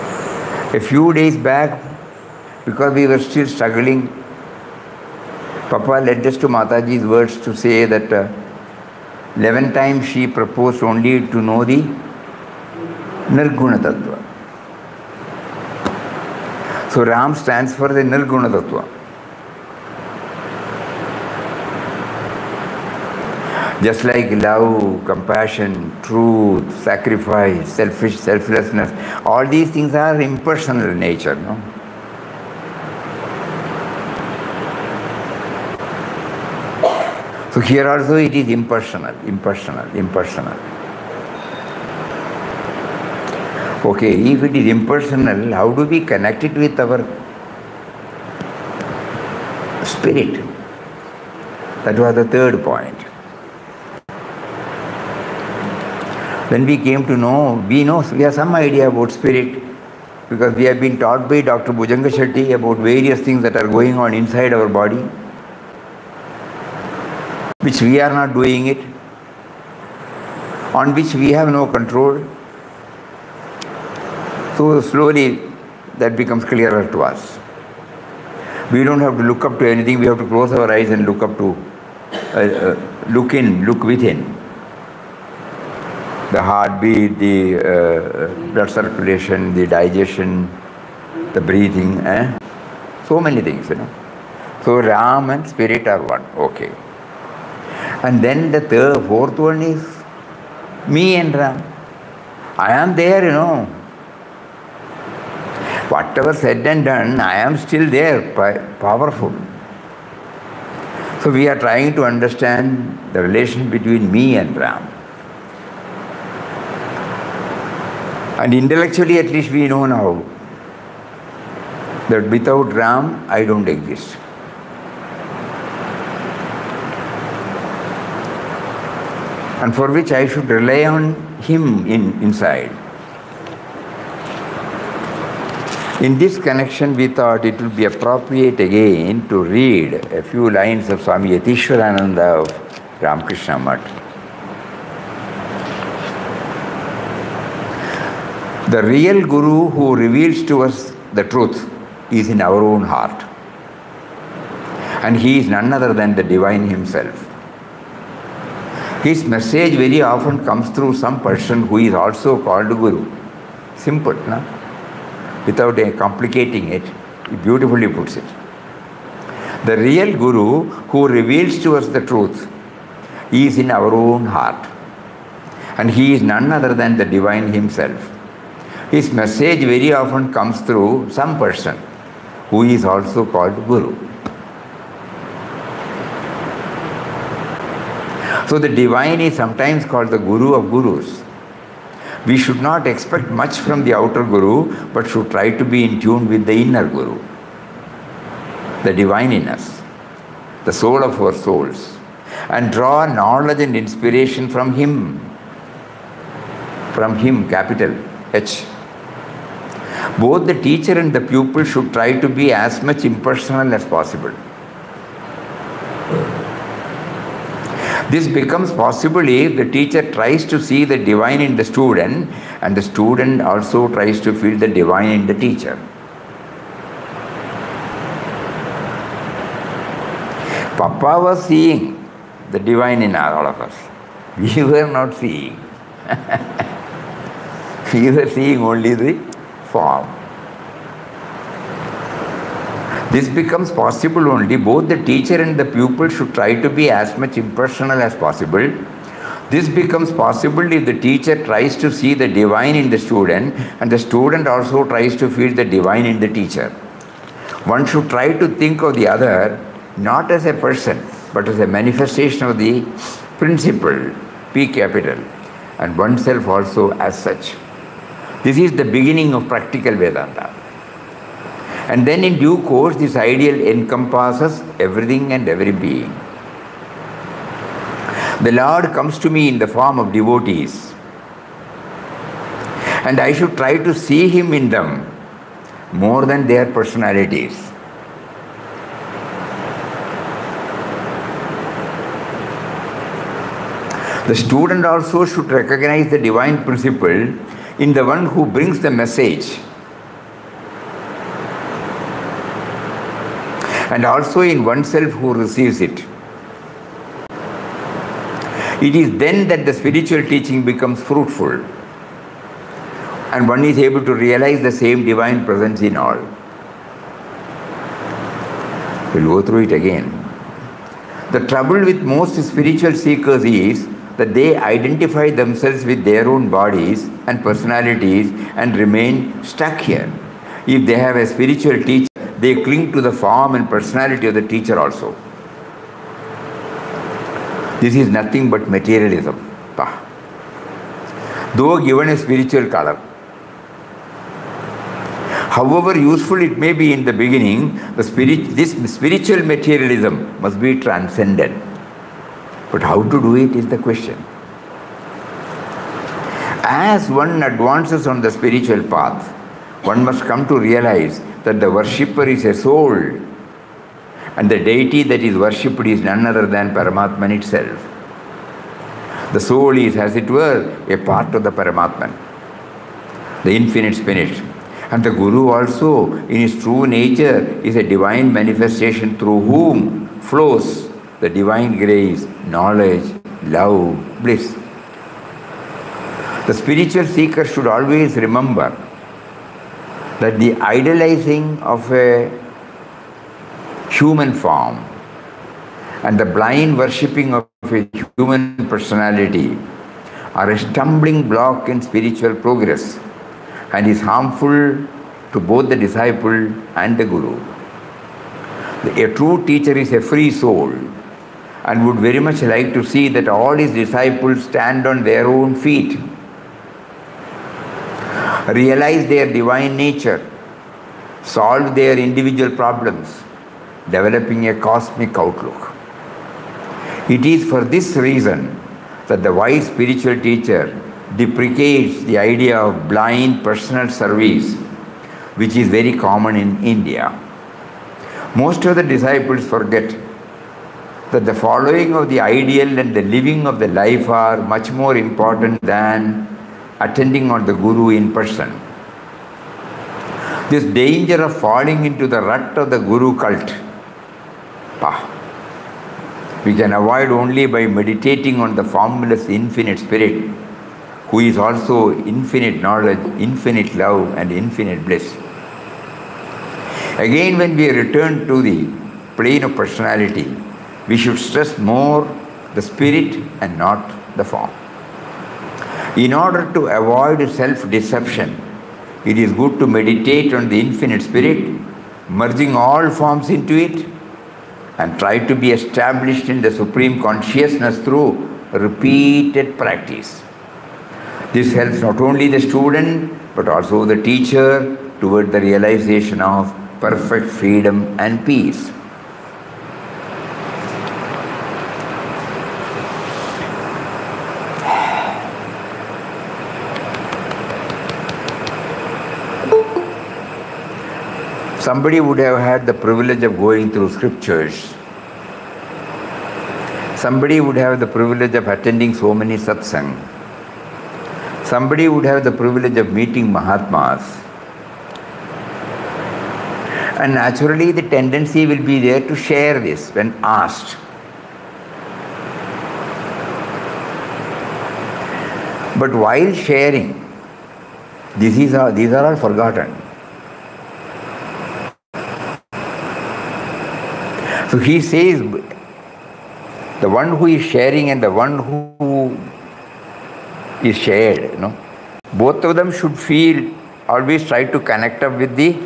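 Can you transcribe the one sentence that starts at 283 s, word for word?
And I should try to see Him in them more than their personalities.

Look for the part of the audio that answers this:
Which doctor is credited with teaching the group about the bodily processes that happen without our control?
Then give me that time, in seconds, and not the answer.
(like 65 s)
61 s.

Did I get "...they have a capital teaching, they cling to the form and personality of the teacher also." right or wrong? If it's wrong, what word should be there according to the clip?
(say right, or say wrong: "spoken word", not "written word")
wrong: "spiritual", not "capital".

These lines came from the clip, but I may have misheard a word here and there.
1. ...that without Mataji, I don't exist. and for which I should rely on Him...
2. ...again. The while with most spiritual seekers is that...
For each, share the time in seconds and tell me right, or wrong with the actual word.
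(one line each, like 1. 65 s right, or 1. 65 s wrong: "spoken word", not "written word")
1. 122 s wrong: "Ram", not "Mataji"
2. 319 s wrong: "trouble", not "while".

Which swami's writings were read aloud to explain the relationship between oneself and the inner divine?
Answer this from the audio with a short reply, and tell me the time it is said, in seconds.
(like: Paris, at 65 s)
Swami Yatishwarananda, at 141 s.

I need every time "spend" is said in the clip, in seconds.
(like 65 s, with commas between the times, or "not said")
not said.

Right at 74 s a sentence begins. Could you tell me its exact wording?
So slowly that becomes clearer to us.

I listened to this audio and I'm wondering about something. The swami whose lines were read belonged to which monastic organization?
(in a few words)
Ramakrishna Math.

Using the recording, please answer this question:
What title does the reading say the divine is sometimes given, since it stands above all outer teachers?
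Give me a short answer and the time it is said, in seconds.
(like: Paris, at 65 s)
guru of gurus, at 190 s.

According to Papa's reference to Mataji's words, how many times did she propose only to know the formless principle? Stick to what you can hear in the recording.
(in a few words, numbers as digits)
11.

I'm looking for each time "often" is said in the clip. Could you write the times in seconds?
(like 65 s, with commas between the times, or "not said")
160 s, 179 s.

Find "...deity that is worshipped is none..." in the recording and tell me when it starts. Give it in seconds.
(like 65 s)
364 s.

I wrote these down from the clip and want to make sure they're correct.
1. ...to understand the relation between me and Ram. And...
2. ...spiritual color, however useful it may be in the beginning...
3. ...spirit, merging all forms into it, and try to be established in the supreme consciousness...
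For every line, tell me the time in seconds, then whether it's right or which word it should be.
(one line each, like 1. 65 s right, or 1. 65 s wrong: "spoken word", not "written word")
1. 111 s right
2. 342 s right
3. 481 s right.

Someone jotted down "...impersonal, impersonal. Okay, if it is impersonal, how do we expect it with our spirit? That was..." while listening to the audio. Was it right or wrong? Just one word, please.
wrong.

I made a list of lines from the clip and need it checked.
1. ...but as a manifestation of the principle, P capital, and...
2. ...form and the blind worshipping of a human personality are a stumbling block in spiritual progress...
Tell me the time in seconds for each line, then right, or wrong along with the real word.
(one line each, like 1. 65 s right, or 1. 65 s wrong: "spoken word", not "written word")
1. 261 s right
2. 394 s right.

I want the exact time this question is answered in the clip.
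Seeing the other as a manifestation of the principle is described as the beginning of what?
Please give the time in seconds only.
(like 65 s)
269 s.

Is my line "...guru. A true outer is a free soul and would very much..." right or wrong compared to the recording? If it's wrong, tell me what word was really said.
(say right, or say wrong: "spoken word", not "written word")
wrong: "teacher", not "outer".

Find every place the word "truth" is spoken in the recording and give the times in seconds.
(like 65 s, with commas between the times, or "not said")
26 s, 151 s, 172 s.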